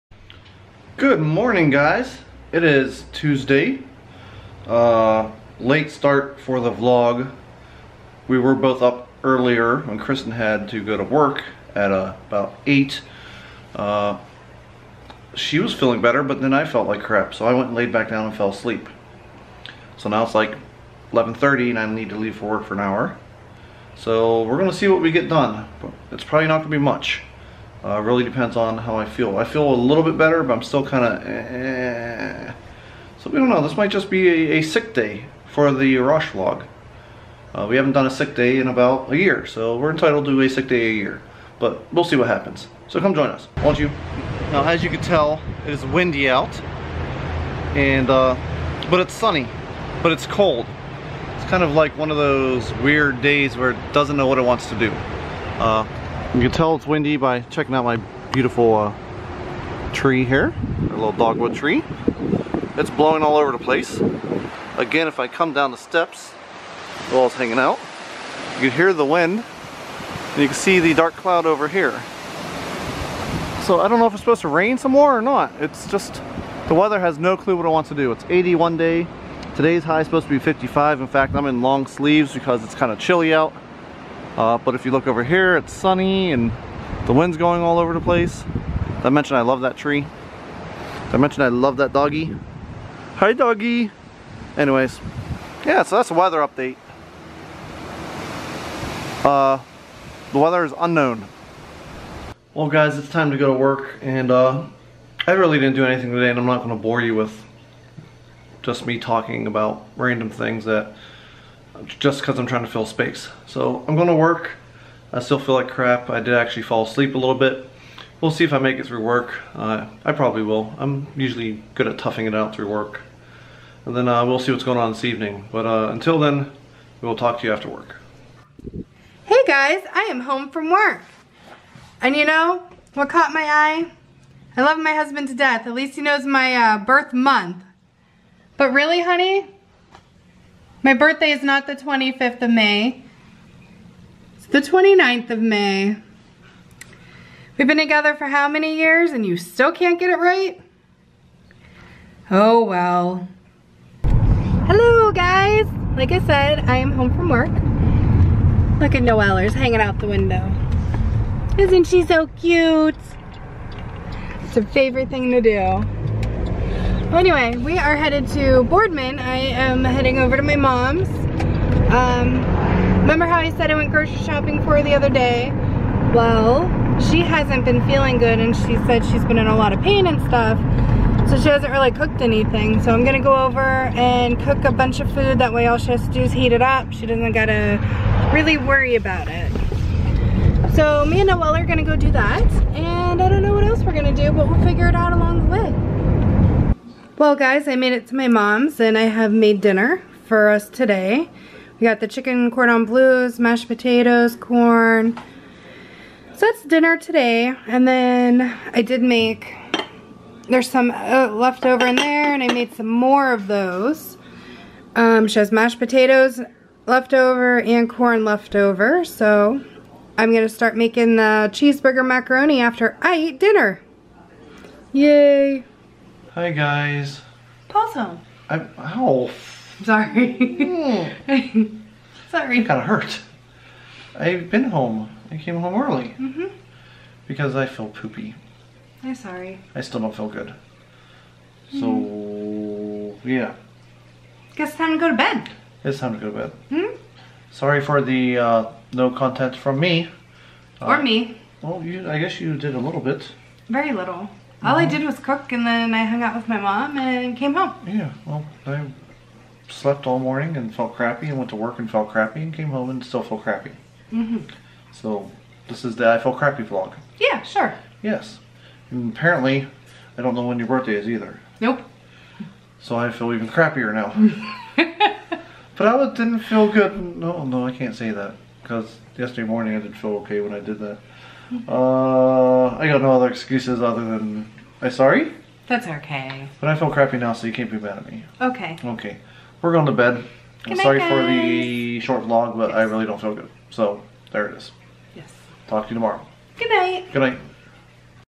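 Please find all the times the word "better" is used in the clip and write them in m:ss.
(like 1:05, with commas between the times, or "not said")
0:16, 0:30.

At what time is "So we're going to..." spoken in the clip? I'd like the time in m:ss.
0:23.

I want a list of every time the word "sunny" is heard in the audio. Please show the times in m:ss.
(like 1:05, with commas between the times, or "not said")
0:49, 1:25.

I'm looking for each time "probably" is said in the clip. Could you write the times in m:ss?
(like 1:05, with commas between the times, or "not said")
0:26, 2:00.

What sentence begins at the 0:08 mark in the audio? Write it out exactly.
We were both up earlier when Kristen had to go to work at uh, about 8.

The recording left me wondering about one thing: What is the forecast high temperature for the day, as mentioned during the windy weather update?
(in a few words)
55.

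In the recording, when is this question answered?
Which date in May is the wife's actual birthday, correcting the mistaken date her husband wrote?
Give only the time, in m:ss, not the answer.
2:24.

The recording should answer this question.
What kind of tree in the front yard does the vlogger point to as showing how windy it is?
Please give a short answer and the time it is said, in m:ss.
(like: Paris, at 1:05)
Dogwood, at 1:01.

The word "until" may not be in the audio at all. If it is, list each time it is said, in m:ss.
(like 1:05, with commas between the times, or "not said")
2:05.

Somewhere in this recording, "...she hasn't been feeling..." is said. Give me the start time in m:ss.
2:57.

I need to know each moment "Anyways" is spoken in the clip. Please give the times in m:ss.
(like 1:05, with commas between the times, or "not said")
1:34, 2:47.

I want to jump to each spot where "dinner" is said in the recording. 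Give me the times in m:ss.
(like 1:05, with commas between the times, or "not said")
3:19, 3:26, 3:43.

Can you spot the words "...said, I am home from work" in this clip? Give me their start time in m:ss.
2:36.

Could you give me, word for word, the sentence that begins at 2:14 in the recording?
I love my husband to death.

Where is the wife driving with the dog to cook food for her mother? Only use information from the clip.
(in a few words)
Boardman.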